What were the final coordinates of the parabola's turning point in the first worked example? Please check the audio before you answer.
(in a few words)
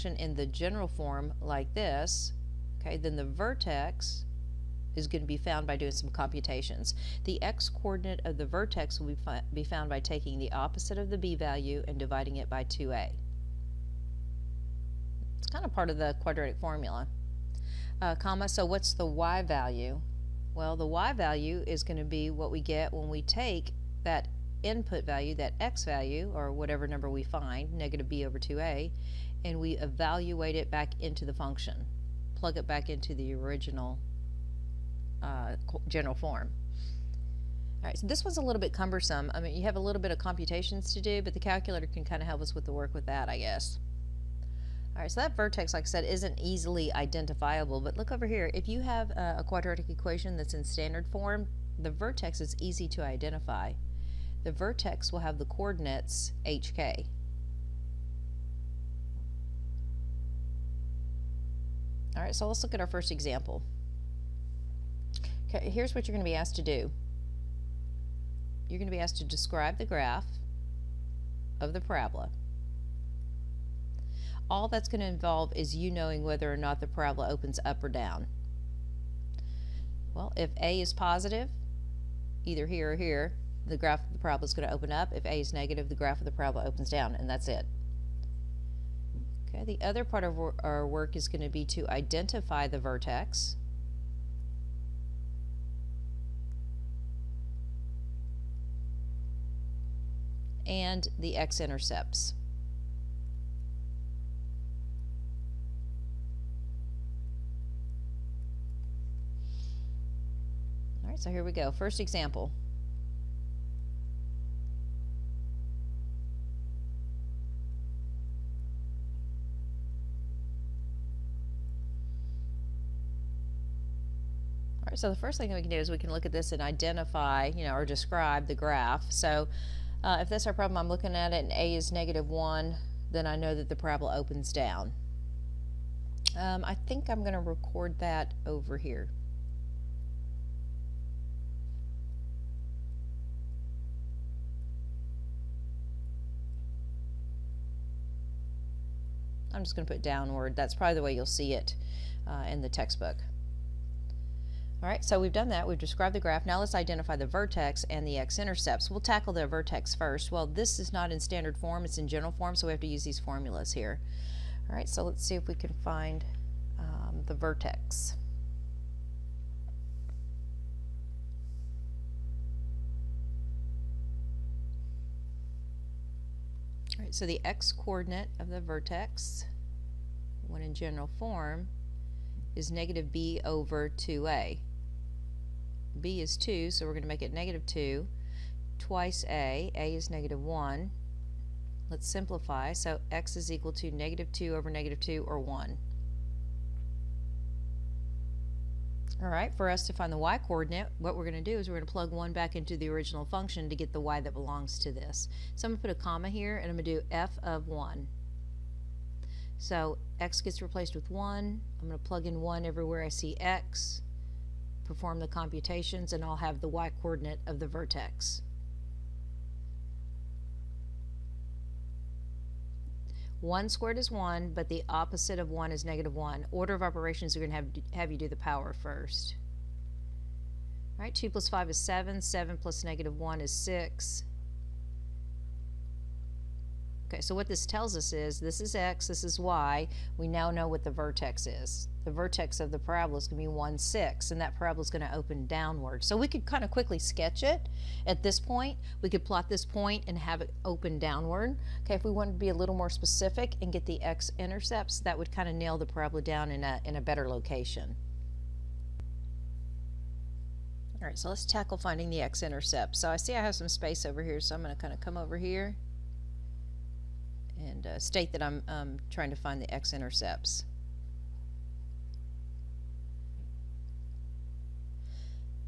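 1, 6.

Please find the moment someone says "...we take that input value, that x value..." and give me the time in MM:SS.
00:23.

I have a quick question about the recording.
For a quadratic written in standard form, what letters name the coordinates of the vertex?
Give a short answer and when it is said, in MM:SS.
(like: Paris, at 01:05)
hk, at 00:56.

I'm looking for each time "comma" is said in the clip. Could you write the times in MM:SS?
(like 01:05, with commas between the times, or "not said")
00:18, 03:26.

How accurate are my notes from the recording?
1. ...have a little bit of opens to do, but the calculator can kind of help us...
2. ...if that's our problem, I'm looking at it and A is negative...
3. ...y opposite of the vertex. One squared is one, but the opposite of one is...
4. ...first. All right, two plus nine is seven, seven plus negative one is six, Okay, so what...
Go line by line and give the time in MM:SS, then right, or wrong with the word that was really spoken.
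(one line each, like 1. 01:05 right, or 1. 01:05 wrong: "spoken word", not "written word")
1. 00:39 wrong: "computations", not "opens"
2. 02:10 right
3. 03:36 wrong: "coordinate", not "opposite"
4. 03:48 wrong: "five", not "nine".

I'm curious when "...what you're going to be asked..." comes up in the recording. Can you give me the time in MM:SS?
01:05.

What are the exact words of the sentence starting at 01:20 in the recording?
Well, if A is positive, either here or here, the graph of the parabola is going to open up.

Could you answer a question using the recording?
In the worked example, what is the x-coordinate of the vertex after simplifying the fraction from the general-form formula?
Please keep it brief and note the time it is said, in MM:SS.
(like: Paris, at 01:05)
1, at 03:13.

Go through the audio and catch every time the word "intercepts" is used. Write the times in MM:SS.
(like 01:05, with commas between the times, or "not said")
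01:41, 02:38, 04:14, 04:22, 04:29.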